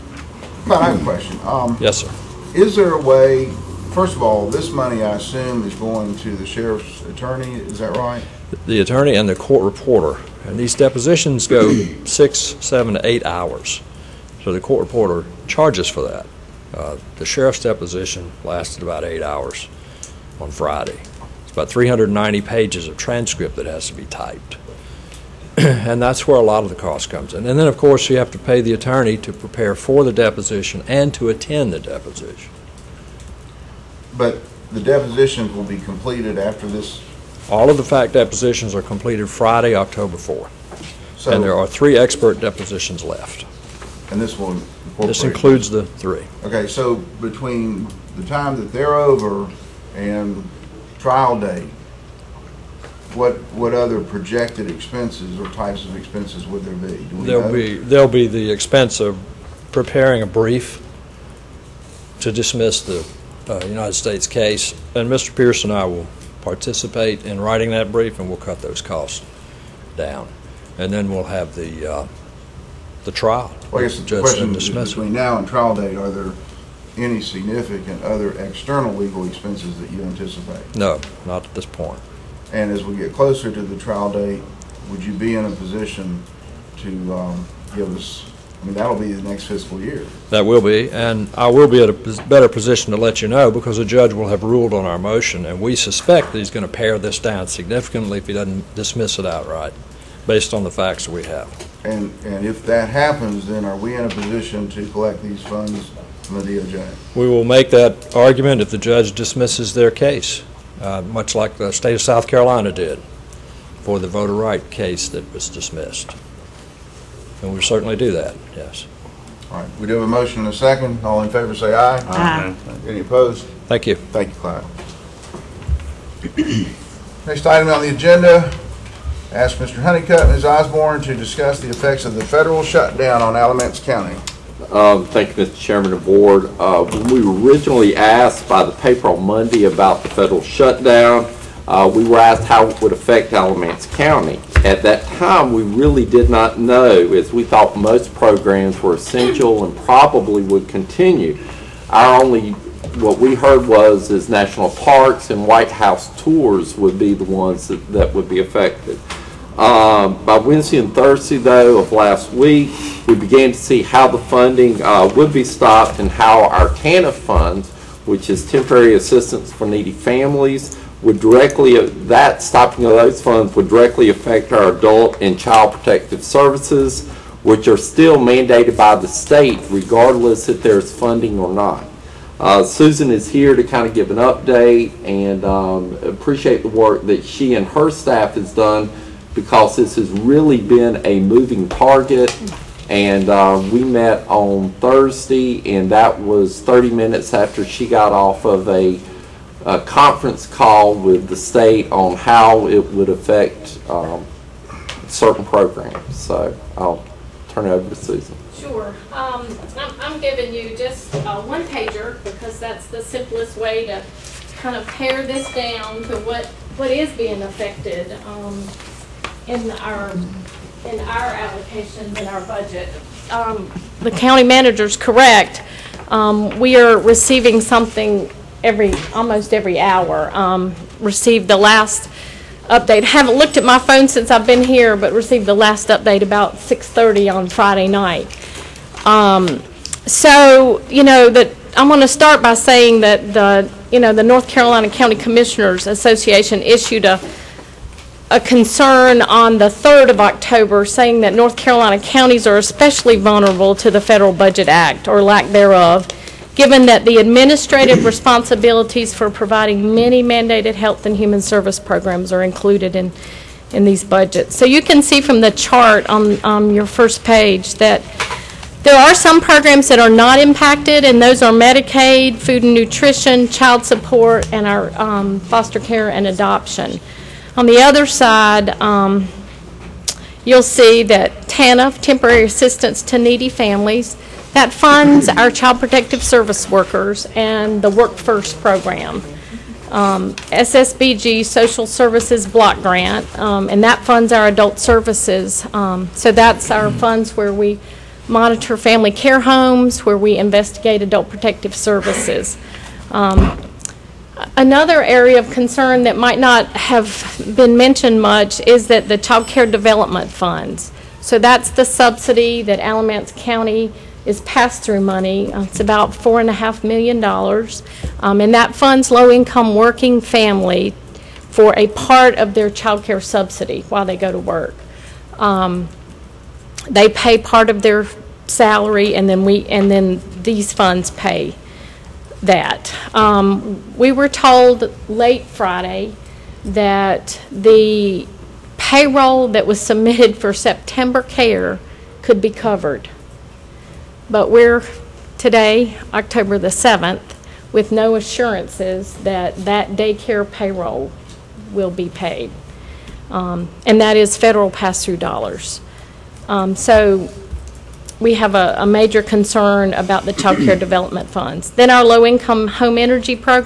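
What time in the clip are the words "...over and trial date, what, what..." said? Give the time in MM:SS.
00:48.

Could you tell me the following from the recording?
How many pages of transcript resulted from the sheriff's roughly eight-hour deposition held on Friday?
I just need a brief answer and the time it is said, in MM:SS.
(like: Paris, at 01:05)
390, at 00:21.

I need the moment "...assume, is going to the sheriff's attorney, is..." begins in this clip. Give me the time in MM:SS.
00:05.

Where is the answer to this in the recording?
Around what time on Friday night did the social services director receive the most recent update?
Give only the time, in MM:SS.
03:56.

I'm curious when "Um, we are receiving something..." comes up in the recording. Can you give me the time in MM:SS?
03:46.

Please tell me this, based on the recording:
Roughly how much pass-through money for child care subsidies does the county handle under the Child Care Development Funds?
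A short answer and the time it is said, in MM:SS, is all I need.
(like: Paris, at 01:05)
four and a half million dollars, at 05:16.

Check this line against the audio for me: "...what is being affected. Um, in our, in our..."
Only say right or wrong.
right.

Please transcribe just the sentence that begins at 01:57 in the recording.
And we certainly do that, yes.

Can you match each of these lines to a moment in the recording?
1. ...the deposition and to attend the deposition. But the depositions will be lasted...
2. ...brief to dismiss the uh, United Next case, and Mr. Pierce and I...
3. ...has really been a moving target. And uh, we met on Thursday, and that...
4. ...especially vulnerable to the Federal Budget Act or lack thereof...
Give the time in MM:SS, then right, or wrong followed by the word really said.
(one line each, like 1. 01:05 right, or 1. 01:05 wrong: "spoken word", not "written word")
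1. 00:30 wrong: "completed", not "lasted"
2. 01:00 wrong: "States", not "Next"
3. 03:09 right
4. 04:12 right.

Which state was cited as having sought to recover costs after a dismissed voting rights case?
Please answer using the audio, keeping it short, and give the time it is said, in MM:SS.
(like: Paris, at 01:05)
South Carolina, at 01:52.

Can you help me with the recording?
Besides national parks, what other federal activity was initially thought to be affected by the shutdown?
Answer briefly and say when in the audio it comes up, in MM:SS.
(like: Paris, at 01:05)
White House tours, at 02:35.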